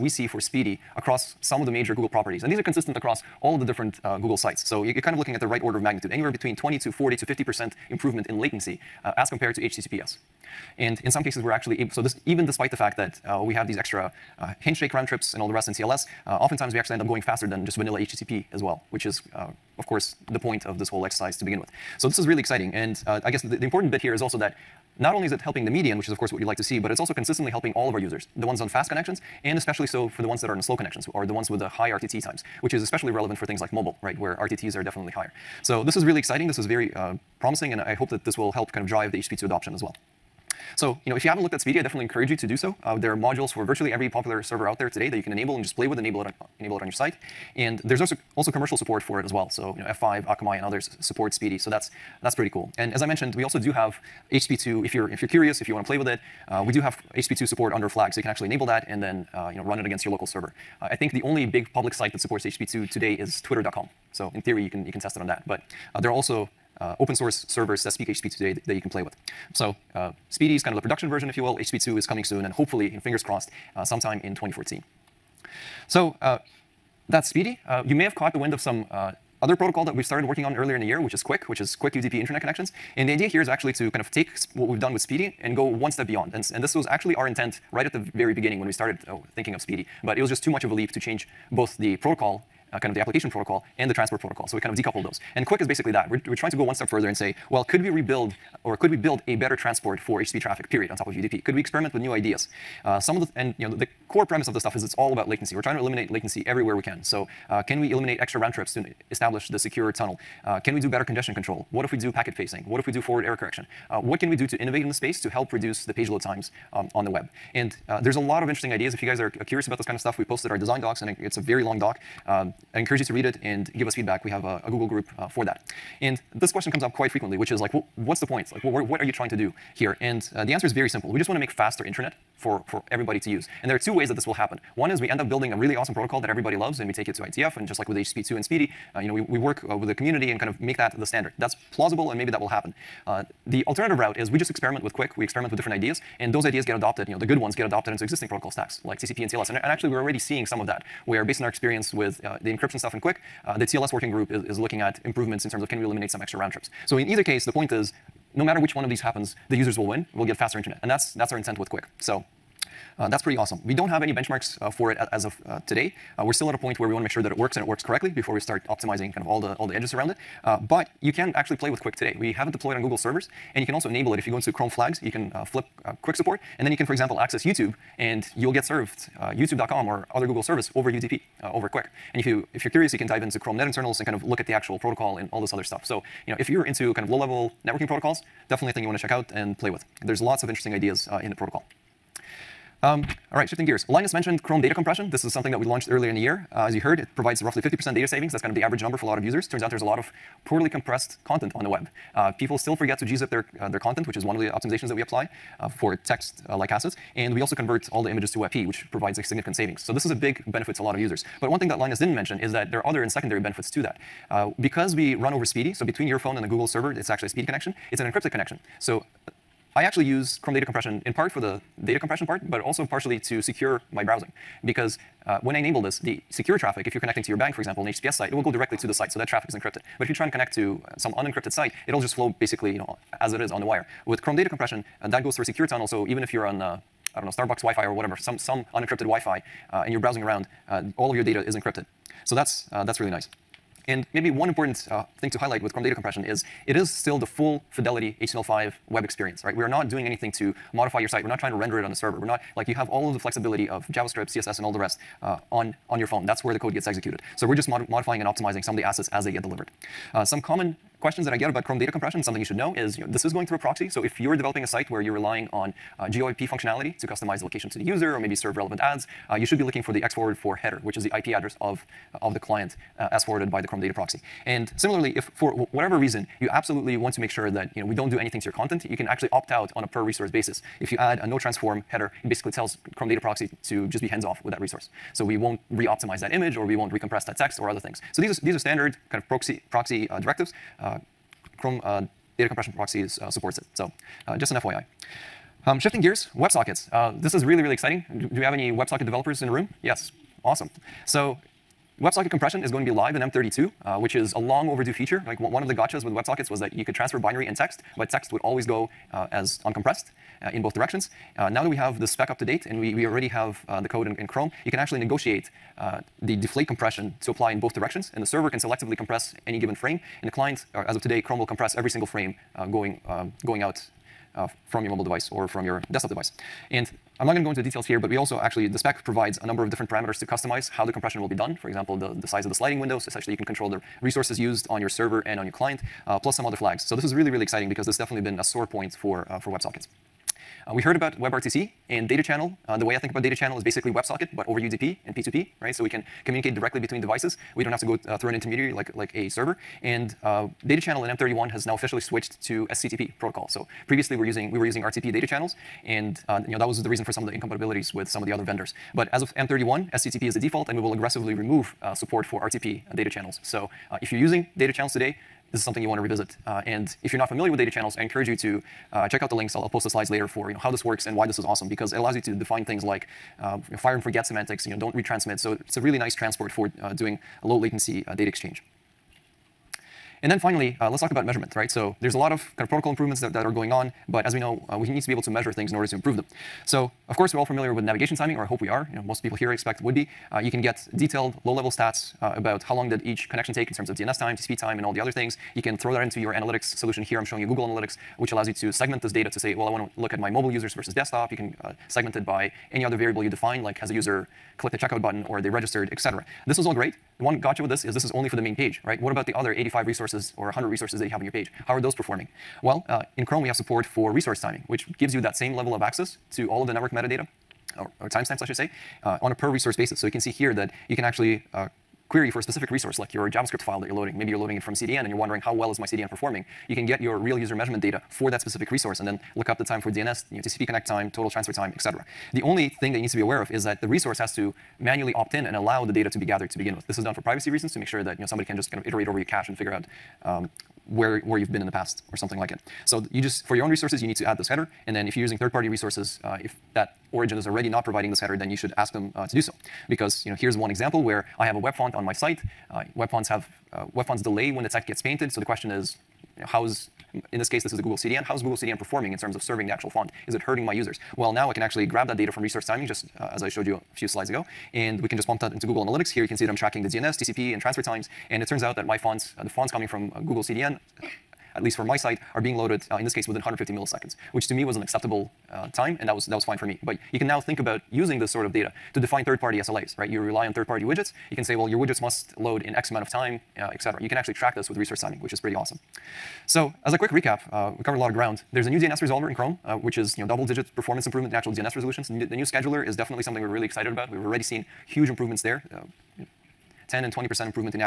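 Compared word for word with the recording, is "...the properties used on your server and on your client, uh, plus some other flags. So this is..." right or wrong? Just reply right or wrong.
wrong.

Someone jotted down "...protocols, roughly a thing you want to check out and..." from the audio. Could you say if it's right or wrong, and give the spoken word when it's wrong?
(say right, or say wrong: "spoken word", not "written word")
wrong: "definitely", not "roughly".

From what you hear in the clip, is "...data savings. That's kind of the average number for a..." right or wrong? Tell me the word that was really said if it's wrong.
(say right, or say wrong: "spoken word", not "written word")
right.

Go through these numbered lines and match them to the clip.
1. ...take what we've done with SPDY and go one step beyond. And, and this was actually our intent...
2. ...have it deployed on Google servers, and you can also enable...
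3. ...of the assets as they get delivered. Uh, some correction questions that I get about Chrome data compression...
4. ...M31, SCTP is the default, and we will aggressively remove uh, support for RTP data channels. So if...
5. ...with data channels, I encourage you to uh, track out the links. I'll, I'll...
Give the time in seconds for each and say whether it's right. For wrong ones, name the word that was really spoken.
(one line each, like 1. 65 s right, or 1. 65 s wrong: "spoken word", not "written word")
1. 84 s right
2. 172 s right
3. 258 s wrong: "common", not "correction"
4. 359 s right
5. 367 s wrong: "check", not "track".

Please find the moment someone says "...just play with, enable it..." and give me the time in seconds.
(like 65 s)
45 s.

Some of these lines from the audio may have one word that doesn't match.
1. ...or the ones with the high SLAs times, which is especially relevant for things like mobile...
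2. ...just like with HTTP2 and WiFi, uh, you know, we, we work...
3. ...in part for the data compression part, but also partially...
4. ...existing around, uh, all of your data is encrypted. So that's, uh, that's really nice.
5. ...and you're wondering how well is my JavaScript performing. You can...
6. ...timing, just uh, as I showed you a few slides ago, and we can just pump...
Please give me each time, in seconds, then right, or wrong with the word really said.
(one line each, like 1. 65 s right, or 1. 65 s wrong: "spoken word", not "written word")
1. 31 s wrong: "RTT", not "SLAs"
2. 137 s wrong: "SPDY", not "WiFi"
3. 221 s right
4. 239 s wrong: "browsing", not "existing"
5. 425 s wrong: "CDN", not "JavaScript"
6. 462 s right.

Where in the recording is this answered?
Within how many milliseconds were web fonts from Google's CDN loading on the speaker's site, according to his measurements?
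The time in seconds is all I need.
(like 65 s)
473 s.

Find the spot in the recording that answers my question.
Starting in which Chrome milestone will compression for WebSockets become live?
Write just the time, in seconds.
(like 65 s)
303 s.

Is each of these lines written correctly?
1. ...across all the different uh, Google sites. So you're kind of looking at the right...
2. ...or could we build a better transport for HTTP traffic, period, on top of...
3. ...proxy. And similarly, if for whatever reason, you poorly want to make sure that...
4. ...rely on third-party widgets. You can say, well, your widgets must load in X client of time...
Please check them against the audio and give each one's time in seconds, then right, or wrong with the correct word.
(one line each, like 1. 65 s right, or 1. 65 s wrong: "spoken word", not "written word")
1. 2 s right
2. 98 s right
3. 273 s wrong: "absolutely", not "poorly"
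4. 480 s wrong: "amount", not "client".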